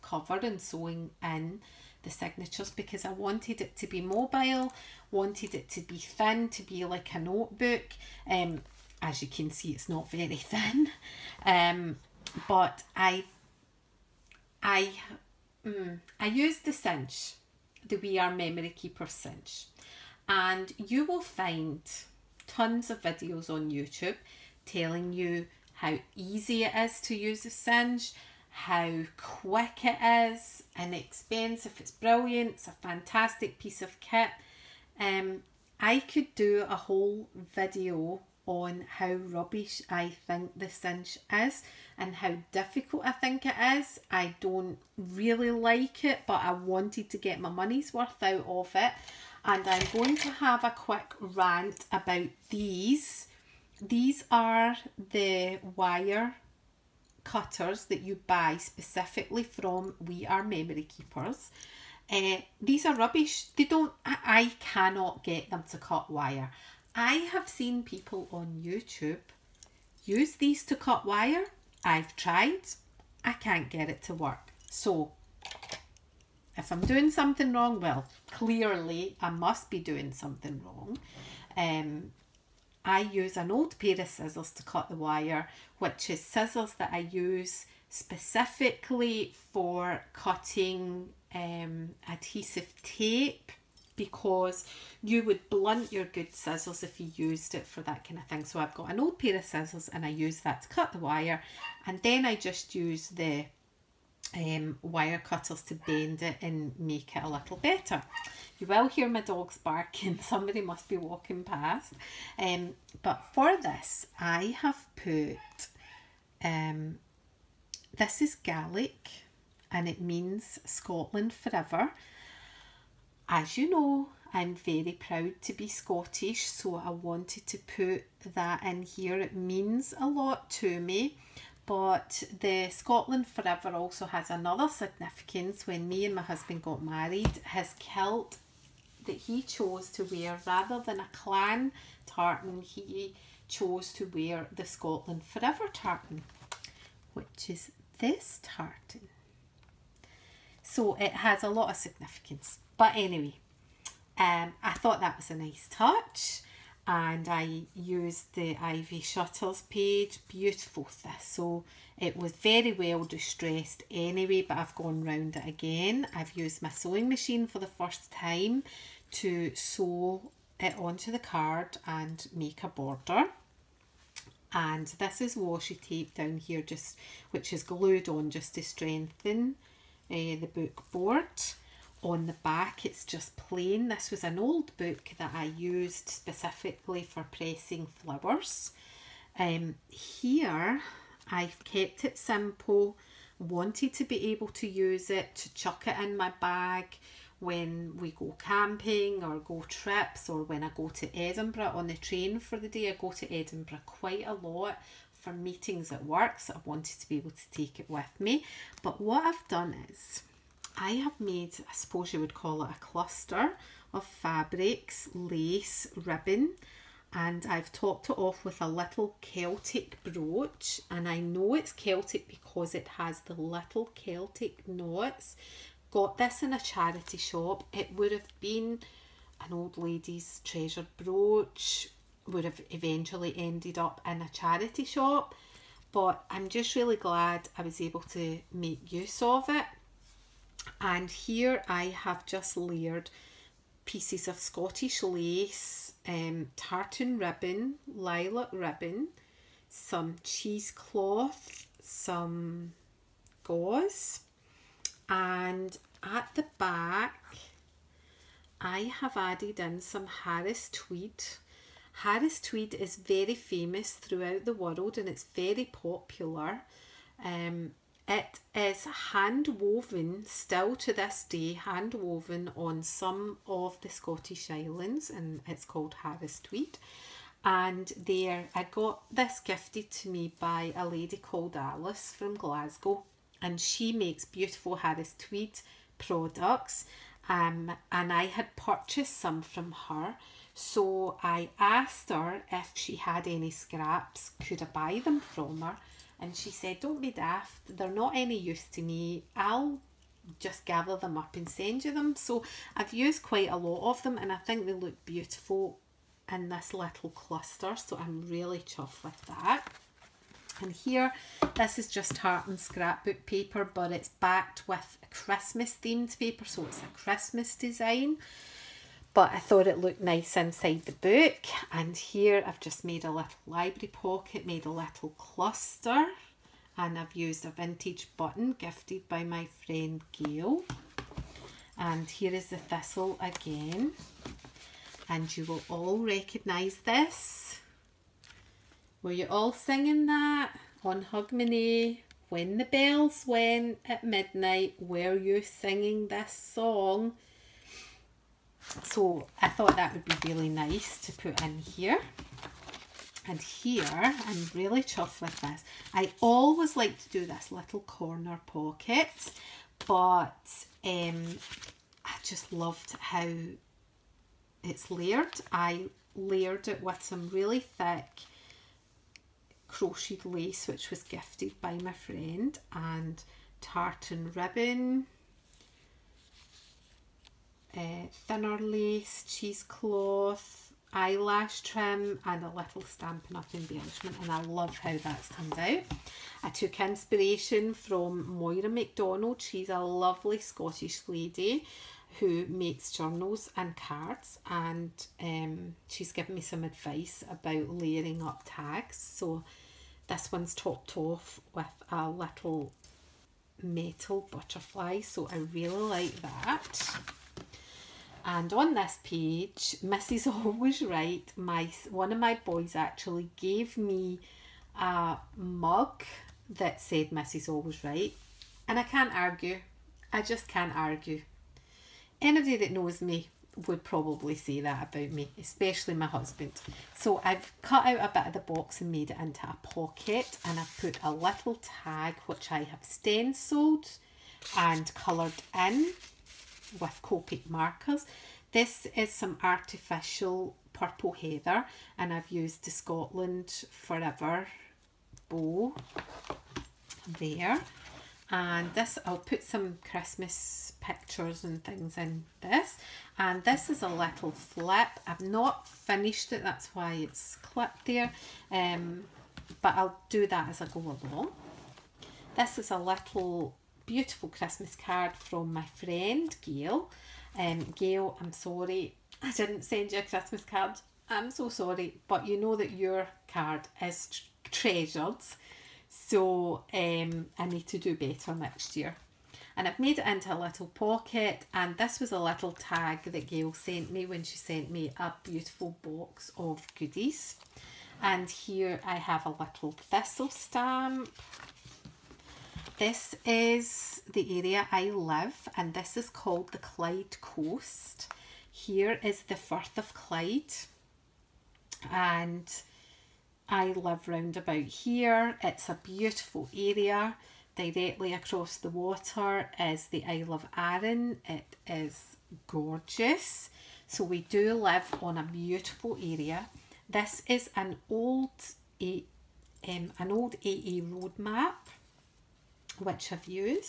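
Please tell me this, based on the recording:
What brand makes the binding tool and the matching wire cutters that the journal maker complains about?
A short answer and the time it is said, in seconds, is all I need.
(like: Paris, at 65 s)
We Are Memory Keepers, at 17 s.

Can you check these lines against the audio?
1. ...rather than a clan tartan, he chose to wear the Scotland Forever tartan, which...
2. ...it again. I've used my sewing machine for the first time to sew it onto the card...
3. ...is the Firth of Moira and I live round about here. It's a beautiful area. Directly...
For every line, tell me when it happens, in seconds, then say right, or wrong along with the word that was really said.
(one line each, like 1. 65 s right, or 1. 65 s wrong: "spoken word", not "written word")
1. 140 s right
2. 165 s right
3. 499 s wrong: "Clyde", not "Moira".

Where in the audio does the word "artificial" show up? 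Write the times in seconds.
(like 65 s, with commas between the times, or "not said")
439 s.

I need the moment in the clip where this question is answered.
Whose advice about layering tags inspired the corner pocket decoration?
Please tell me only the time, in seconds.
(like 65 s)
388 s.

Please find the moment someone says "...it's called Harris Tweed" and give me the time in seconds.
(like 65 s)
275 s.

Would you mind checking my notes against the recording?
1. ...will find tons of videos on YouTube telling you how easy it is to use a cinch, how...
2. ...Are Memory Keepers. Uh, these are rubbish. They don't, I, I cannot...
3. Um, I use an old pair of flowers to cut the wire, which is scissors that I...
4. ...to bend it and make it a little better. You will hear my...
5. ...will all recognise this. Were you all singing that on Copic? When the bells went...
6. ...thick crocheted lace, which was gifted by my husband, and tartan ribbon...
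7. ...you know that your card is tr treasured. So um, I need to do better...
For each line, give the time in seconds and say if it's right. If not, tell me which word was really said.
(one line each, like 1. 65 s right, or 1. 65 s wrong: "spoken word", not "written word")
1. 21 s right
2. 60 s right
3. 81 s wrong: "scissors", not "flowers"
4. 105 s right
5. 335 s wrong: "Hogmanay", not "Copic"
6. 367 s wrong: "friend", not "husband"
7. 472 s right.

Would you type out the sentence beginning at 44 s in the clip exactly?
I don't really like it, but I wanted to get my money's worth out of it.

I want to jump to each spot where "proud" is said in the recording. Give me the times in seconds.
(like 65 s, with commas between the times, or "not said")
124 s.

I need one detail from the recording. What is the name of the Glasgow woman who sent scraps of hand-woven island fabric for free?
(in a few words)
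Alice.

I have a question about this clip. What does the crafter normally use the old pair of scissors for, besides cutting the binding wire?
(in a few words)
adhesive tape.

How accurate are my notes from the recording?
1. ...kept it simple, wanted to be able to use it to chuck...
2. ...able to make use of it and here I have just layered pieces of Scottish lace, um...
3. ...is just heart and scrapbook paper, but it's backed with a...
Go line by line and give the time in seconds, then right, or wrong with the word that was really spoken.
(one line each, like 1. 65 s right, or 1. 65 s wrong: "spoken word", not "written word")
1. 191 s right
2. 237 s right
3. 311 s right.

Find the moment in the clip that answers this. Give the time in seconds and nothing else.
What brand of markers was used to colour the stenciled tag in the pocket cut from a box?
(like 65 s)
437 s.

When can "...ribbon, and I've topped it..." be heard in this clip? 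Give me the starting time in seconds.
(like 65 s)
216 s.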